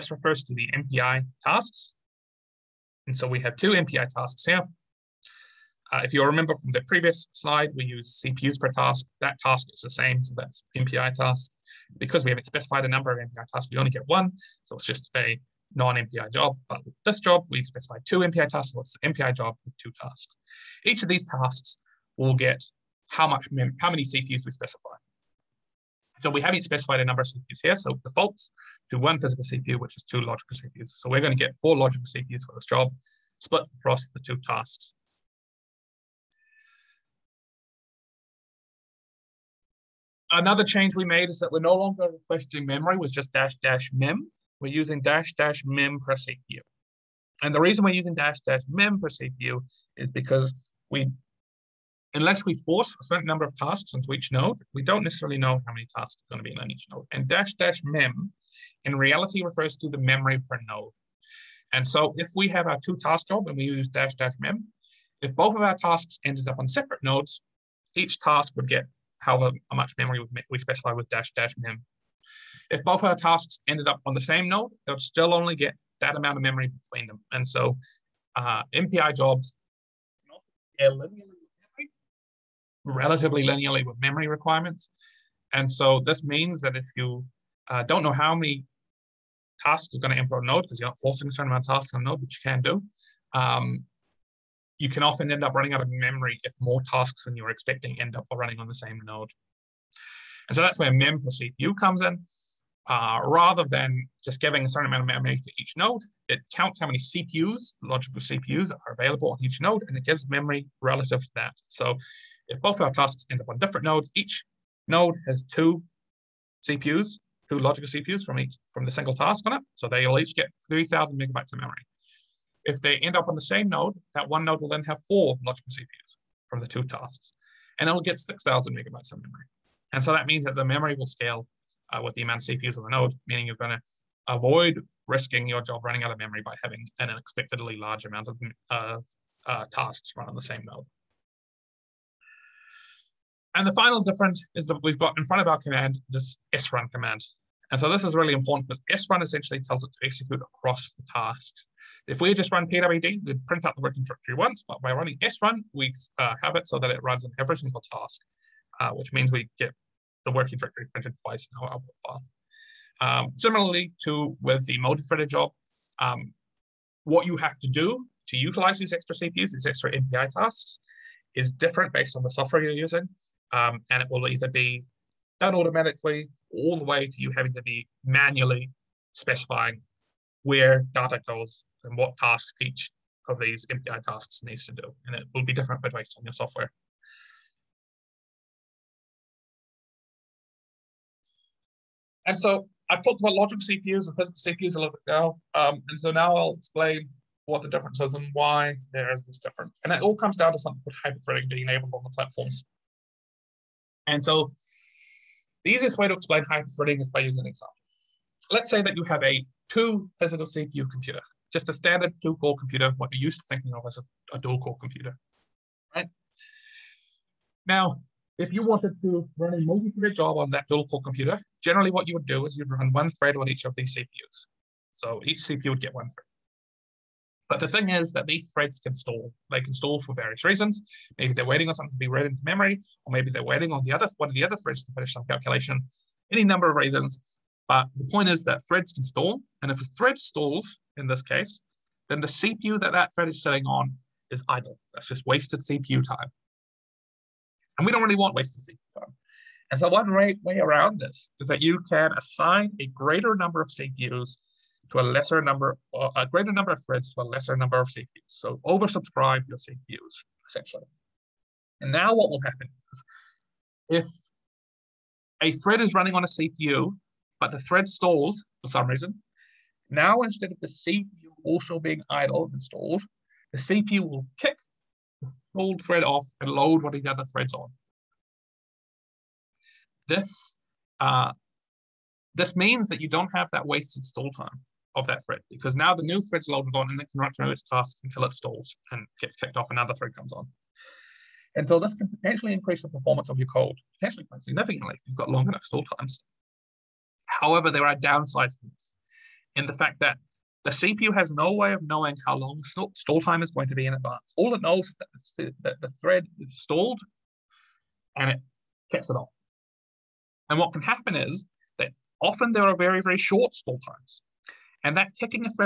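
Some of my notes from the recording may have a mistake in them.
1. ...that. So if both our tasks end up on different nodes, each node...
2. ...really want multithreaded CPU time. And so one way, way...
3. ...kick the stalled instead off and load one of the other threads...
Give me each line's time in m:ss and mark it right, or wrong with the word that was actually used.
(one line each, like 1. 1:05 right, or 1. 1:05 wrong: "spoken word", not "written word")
1. 1:51 right
2. 4:08 wrong: "wasted", not "multithreaded"
3. 4:34 wrong: "thread", not "instead".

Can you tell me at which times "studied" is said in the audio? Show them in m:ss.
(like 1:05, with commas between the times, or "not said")
not said.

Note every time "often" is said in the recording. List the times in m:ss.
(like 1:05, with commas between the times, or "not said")
1:35, 5:12.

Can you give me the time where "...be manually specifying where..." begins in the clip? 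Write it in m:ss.
2:57.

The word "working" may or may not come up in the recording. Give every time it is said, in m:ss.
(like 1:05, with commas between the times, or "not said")
2:33, 2:40.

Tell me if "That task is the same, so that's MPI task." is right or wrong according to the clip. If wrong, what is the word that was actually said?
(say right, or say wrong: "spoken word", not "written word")
right.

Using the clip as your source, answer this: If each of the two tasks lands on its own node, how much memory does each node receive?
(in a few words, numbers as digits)
3,000 megabytes.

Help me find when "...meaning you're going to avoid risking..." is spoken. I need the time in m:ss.
2:13.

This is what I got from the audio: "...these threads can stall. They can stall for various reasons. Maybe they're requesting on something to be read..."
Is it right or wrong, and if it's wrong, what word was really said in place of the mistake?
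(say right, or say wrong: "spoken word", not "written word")
wrong: "waiting", not "requesting".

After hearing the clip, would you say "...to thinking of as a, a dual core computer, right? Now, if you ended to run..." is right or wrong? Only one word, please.
wrong.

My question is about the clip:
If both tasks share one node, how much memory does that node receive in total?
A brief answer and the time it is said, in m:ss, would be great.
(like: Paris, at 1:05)
6,000 megabytes, at 2:08.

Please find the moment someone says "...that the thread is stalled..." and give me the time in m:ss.
5:05.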